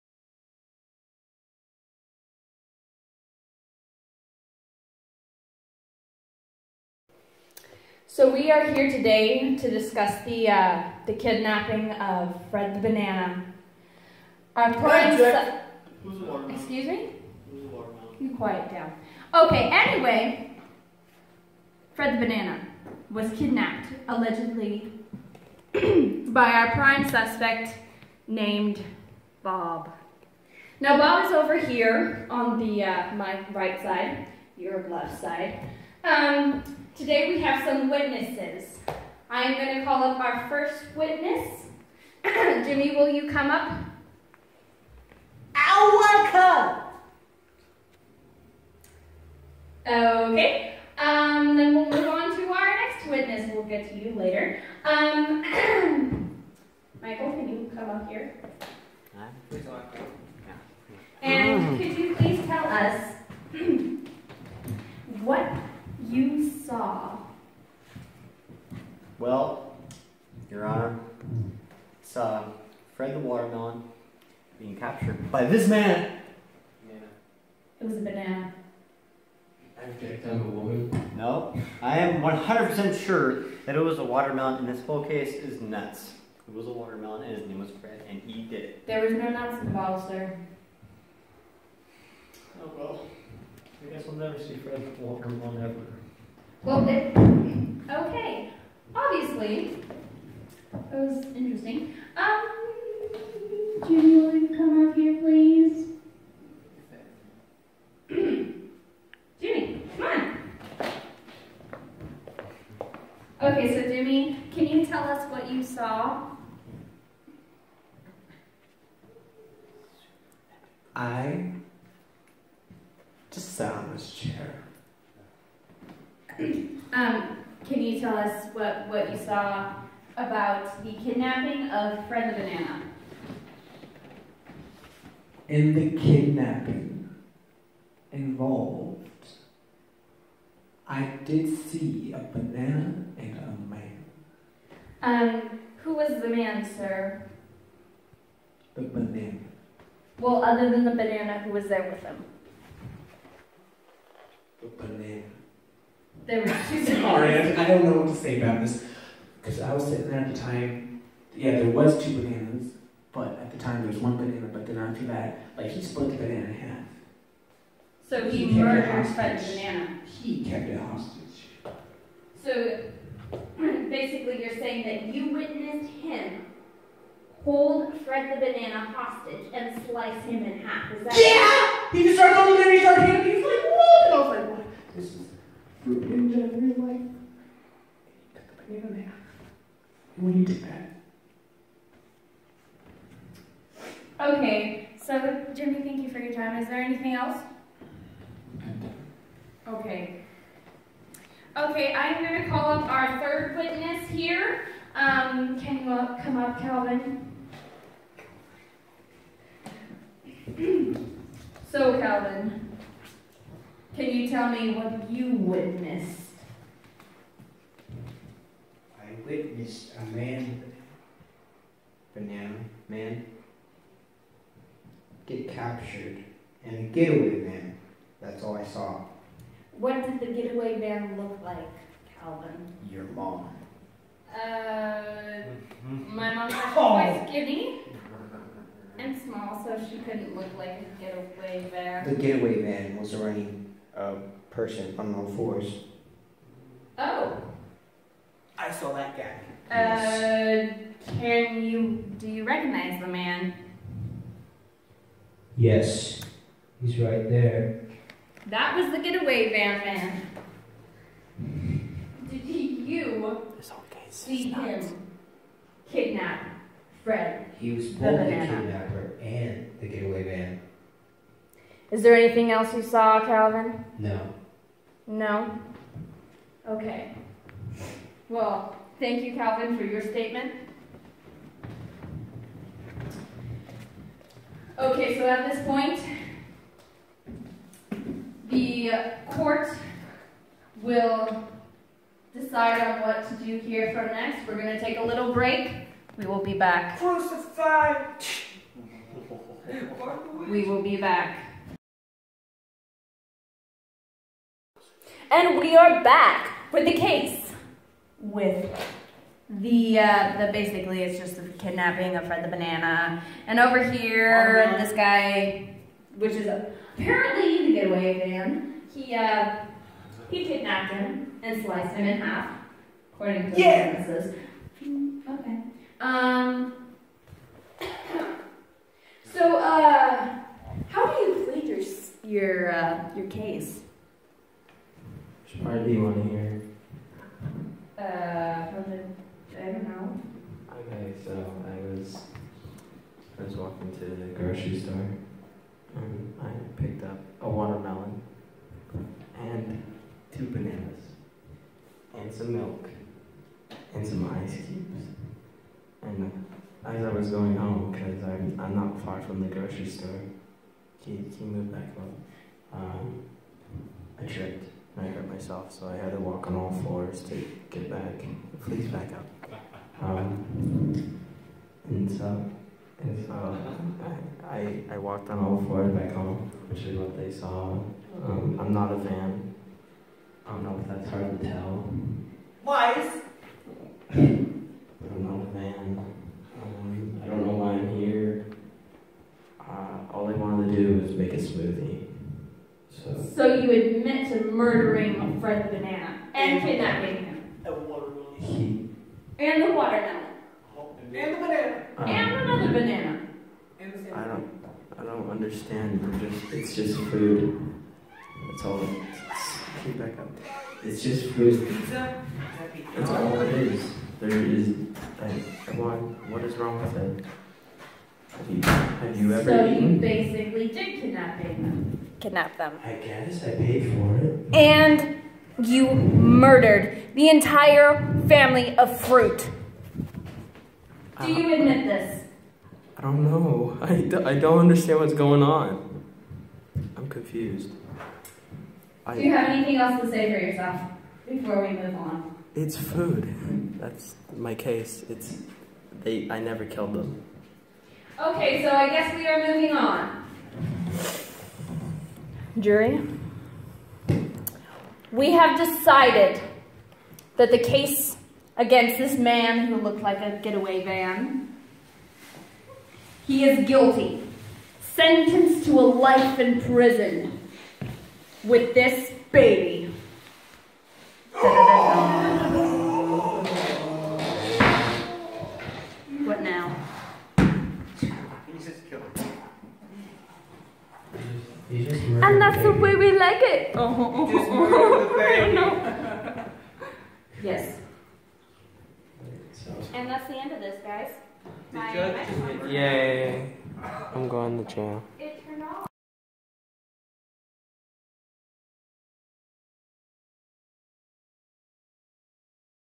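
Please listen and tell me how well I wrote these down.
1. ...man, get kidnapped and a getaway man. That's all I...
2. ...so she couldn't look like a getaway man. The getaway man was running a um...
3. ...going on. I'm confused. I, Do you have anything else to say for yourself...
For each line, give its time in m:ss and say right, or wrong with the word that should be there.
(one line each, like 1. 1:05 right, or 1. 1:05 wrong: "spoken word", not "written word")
1. 3:42 wrong: "captured", not "kidnapped"
2. 3:59 right
3. 7:15 right.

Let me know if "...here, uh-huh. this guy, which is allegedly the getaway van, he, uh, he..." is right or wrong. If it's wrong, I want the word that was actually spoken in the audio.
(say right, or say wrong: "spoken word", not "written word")
wrong: "apparently", not "allegedly".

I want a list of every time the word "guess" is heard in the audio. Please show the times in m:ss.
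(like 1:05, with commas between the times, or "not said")
1:33, 7:02, 7:28.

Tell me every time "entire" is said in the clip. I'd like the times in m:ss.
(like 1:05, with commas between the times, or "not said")
7:07.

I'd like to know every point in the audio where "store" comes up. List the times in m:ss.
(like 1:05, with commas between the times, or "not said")
5:44, 5:59.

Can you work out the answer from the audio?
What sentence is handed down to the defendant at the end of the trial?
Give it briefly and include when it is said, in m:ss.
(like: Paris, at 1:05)
Life in prison, at 7:45.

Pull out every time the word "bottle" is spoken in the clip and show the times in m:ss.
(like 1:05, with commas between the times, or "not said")
1:29.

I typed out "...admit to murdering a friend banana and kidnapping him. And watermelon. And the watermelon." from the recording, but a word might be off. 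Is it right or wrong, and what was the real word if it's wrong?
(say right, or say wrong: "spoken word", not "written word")
right.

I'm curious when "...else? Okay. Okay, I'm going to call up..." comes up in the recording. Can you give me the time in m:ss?
3:17.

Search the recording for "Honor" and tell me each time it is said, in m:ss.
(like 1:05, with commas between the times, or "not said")
1:10.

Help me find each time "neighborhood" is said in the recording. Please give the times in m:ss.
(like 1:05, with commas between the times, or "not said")
not said.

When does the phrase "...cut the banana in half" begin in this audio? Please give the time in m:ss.
3:08.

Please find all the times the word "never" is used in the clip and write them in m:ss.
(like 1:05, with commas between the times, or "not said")
1:34, 7:26.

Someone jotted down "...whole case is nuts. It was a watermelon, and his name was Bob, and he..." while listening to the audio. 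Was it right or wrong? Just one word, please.
wrong.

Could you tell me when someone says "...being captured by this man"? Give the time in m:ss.
1:14.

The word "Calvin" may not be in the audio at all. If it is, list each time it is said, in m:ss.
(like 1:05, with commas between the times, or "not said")
3:26, 3:31, 3:52, 4:33, 4:39.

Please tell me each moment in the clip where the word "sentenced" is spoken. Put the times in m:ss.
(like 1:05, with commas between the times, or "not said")
7:44.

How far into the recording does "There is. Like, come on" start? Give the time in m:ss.
6:54.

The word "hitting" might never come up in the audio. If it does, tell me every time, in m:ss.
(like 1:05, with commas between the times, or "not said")
3:03.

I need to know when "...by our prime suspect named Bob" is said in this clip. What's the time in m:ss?
0:25.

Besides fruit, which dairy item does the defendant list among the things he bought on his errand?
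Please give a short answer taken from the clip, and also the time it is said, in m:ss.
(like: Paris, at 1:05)
Milk, at 5:52.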